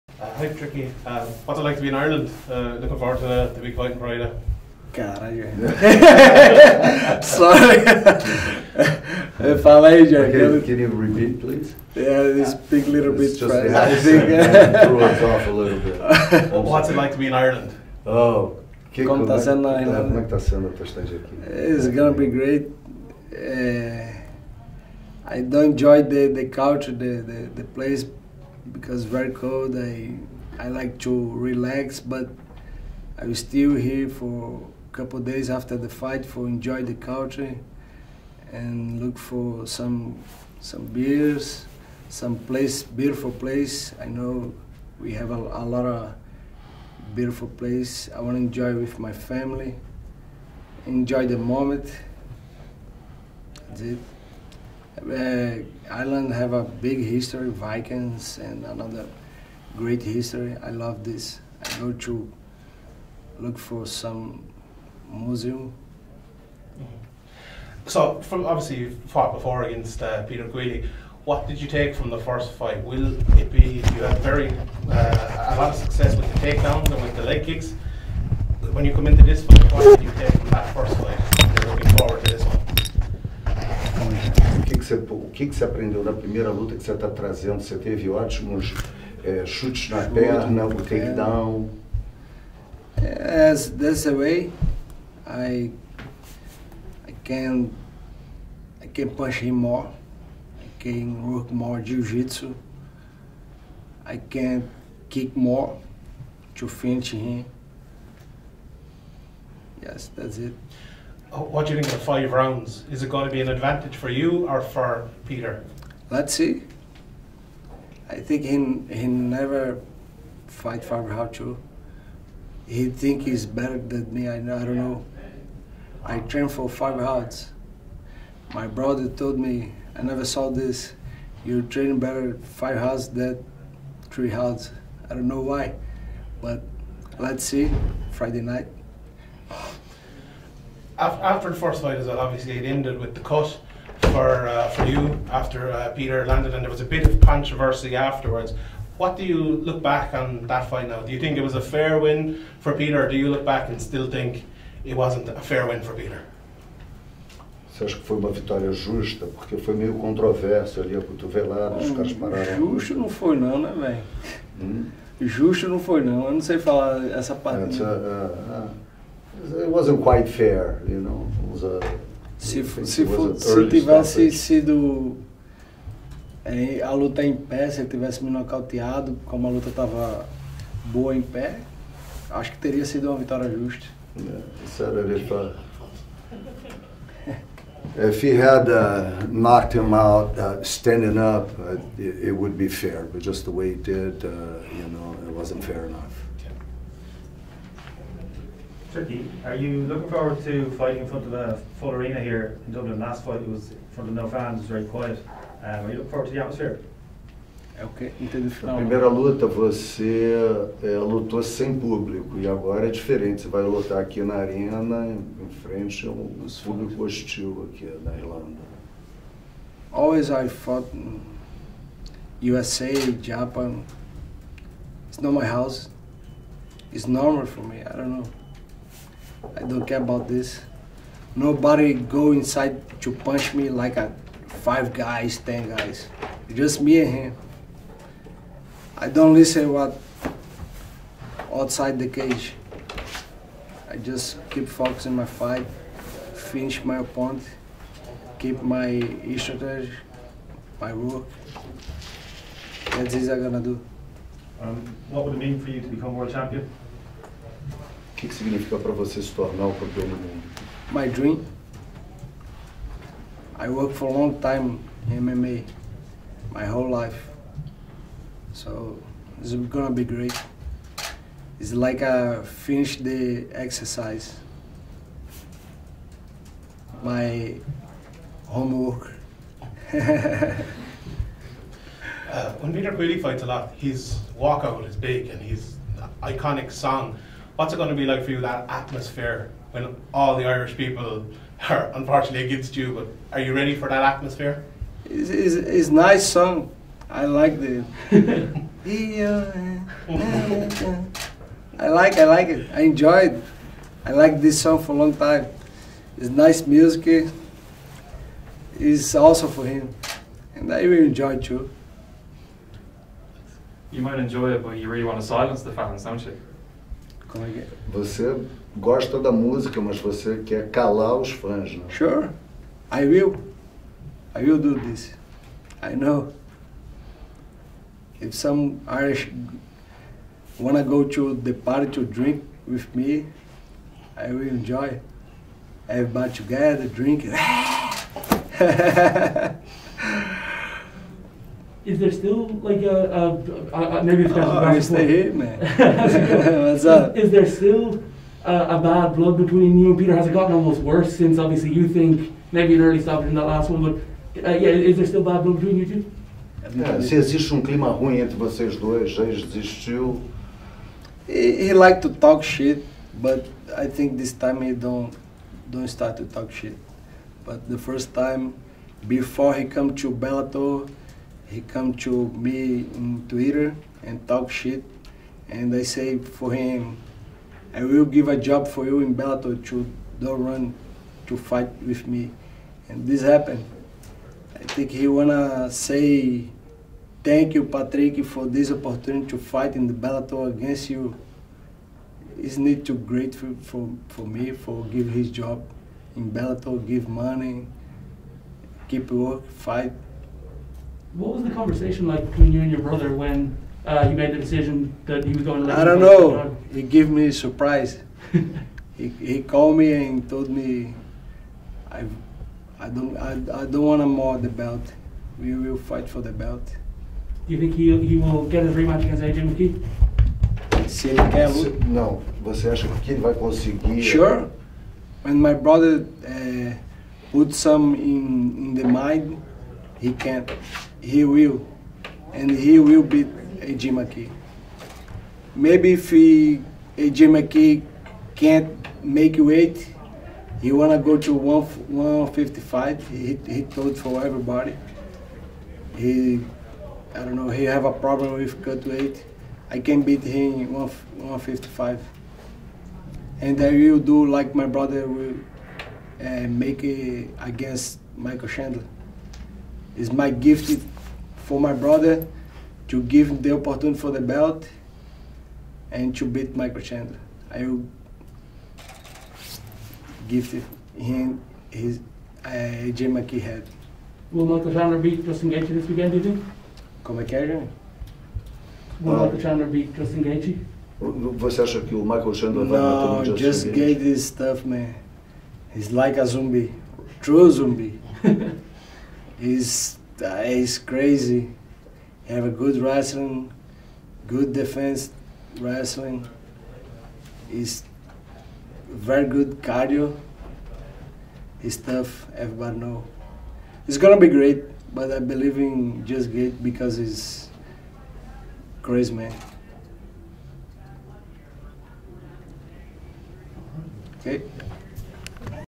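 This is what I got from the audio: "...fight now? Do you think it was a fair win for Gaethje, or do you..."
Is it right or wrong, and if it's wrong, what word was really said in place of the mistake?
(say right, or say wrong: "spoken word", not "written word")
wrong: "Peter", not "Gaethje".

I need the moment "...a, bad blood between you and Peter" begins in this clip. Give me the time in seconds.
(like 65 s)
348 s.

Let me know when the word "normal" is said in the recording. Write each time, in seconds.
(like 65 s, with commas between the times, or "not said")
227 s.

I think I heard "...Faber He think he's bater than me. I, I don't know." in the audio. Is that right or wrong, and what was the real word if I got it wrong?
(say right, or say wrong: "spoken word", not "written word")
wrong: "better", not "bater".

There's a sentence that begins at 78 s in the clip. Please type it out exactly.
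When you come into this fight, what did you take?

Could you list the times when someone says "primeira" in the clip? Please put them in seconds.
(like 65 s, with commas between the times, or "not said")
86 s, 208 s.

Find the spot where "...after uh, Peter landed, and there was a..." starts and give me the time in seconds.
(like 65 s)
145 s.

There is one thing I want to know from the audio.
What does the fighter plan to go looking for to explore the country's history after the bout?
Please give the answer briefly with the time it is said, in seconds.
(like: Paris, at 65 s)
museum, at 65 s.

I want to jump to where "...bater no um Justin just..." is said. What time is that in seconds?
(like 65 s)
482 s.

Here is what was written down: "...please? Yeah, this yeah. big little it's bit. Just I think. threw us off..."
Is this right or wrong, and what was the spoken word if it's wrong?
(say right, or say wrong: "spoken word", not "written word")
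right.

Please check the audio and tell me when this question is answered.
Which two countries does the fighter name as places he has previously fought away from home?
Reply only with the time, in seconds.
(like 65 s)
222 s.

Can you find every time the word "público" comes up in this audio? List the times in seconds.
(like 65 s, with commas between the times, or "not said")
211 s, 216 s.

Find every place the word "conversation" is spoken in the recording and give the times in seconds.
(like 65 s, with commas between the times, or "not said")
401 s.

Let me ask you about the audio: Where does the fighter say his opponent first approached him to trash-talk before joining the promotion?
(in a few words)
Twitter.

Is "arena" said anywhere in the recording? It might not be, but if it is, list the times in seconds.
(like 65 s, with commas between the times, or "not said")
201 s, 214 s.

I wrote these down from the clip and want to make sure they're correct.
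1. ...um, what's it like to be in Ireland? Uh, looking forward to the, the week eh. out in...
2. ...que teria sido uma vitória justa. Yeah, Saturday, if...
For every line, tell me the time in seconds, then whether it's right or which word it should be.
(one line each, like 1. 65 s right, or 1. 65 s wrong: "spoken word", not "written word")
1. 1 s right
2. 182 s right.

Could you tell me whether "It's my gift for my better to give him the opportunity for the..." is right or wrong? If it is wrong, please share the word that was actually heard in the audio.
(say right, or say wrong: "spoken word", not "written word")
wrong: "brother", not "better".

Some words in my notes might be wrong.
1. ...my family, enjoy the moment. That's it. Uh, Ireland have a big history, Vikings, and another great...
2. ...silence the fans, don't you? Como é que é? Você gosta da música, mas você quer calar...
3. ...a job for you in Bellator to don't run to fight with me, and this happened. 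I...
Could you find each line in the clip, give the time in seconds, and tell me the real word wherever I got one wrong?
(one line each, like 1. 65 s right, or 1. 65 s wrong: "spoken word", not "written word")
1. 48 s right
2. 315 s right
3. 378 s right.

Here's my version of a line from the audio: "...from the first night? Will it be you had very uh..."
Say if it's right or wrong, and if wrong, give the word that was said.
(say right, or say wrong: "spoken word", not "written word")
wrong: "fight", not "night".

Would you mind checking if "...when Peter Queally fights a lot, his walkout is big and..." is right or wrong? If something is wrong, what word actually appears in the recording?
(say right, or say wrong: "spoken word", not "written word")
right.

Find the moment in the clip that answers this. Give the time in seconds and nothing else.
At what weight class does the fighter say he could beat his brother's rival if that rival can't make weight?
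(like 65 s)
449 s.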